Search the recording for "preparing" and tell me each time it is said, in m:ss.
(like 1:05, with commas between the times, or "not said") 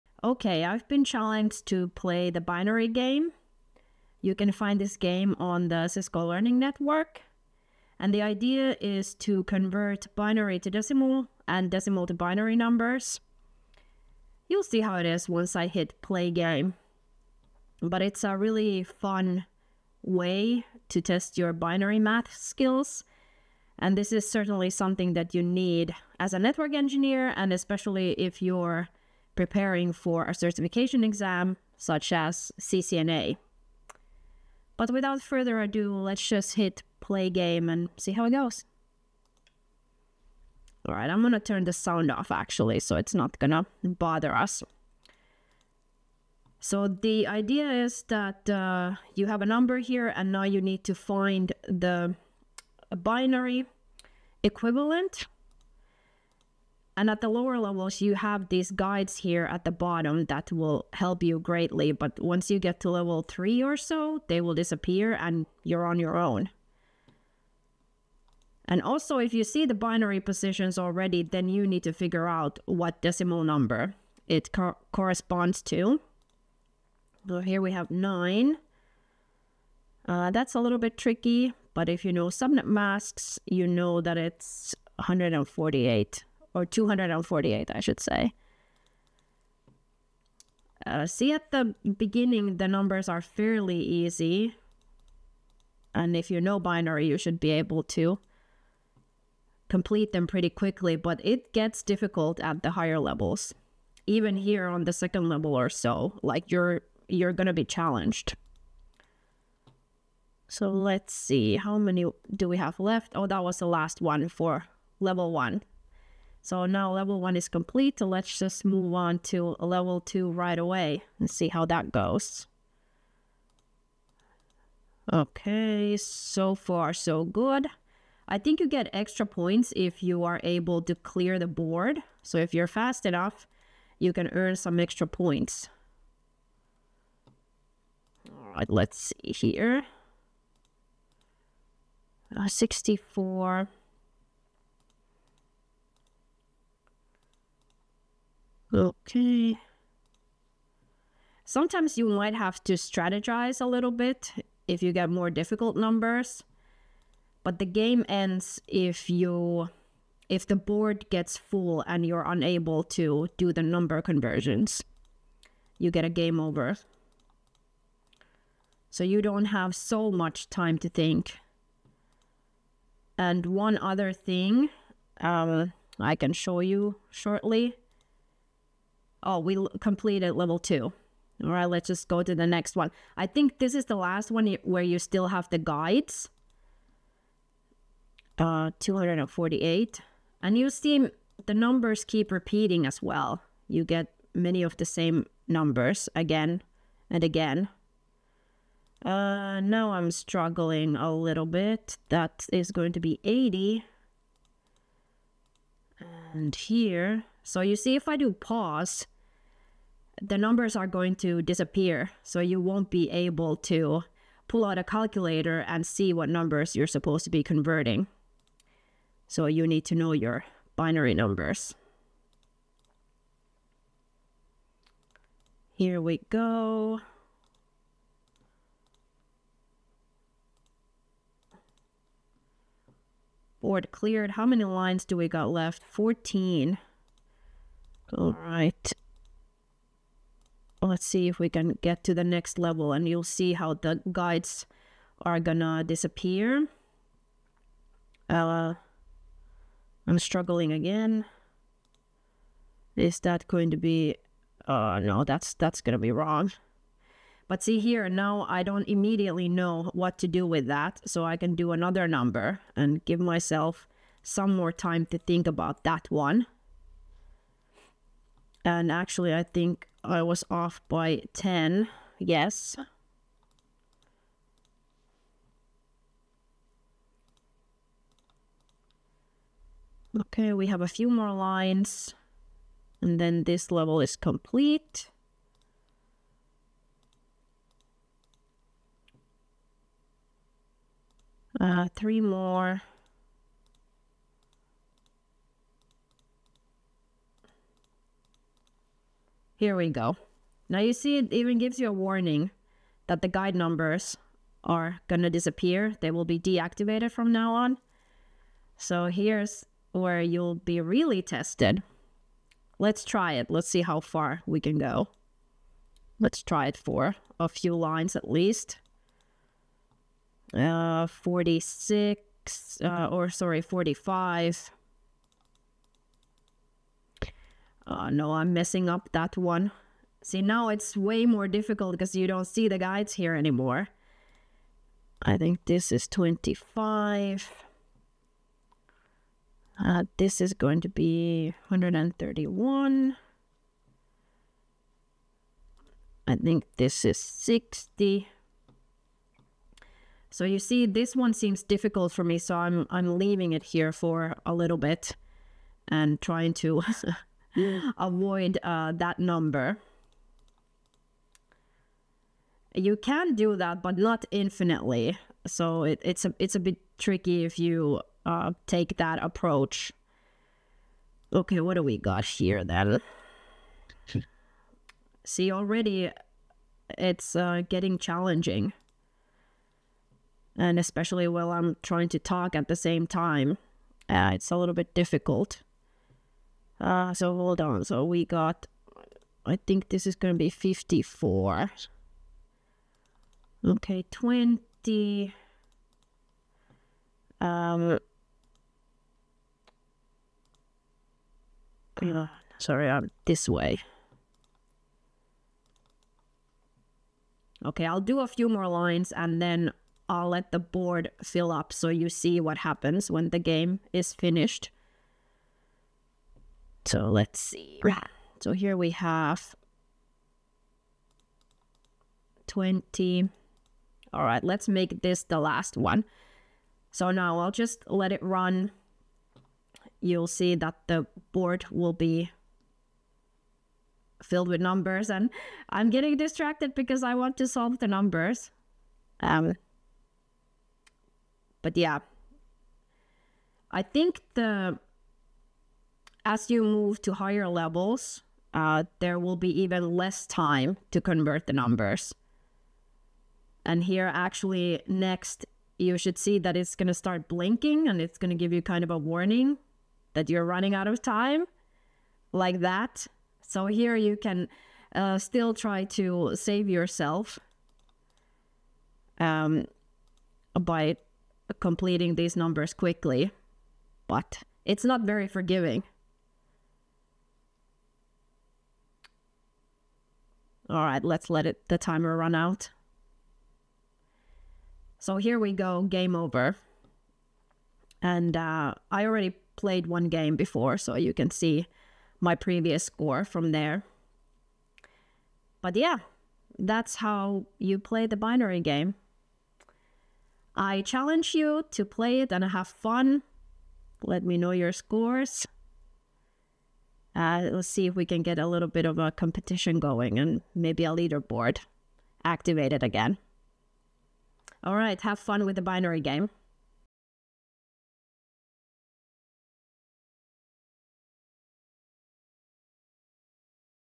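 0:29.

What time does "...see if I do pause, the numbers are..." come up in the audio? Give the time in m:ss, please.
3:27.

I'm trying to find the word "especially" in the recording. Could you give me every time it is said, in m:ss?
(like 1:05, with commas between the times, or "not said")
0:27, 6:20.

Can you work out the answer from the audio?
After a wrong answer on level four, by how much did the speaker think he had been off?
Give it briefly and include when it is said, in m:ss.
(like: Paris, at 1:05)
10, at 4:30.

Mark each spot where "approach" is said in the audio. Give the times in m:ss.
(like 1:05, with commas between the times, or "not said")
6:09.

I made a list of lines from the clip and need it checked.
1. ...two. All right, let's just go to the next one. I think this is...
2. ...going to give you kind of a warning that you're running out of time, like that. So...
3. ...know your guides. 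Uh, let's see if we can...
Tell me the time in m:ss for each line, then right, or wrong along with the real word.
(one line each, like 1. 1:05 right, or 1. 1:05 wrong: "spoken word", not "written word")
1. 3:00 right
2. 7:38 right
3. 8:24 wrong: "scores", not "guides".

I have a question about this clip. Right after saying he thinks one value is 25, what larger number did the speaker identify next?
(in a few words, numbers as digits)
131.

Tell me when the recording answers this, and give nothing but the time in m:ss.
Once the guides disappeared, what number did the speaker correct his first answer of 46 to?
5:23.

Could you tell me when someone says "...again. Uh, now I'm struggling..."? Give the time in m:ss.
3:17.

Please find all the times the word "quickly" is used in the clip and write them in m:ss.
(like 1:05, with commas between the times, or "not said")
1:40, 7:52.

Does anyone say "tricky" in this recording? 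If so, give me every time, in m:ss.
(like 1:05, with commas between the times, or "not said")
1:20, 6:06.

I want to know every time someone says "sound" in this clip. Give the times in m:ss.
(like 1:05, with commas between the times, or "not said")
0:41.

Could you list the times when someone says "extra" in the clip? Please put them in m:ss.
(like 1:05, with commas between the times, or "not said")
2:08, 2:14.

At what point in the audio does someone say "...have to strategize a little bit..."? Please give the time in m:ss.
2:32.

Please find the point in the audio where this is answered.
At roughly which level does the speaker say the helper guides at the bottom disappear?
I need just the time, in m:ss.
1:02.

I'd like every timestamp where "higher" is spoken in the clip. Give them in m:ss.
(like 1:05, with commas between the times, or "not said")
1:42, 7:27.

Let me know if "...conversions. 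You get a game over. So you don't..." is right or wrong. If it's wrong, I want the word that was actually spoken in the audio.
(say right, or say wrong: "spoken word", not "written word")
right.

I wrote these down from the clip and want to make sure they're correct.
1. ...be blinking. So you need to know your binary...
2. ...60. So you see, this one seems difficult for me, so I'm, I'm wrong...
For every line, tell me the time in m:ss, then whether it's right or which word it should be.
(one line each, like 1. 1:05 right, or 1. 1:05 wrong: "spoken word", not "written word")
1. 3:37 wrong: "converting", not "blinking"
2. 5:47 wrong: "leaving", not "wrong".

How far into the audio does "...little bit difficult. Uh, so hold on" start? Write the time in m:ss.
6:24.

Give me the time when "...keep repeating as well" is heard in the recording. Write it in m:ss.
3:12.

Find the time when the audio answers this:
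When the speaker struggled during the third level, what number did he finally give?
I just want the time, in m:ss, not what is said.
3:23.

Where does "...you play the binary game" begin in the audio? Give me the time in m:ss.
8:17.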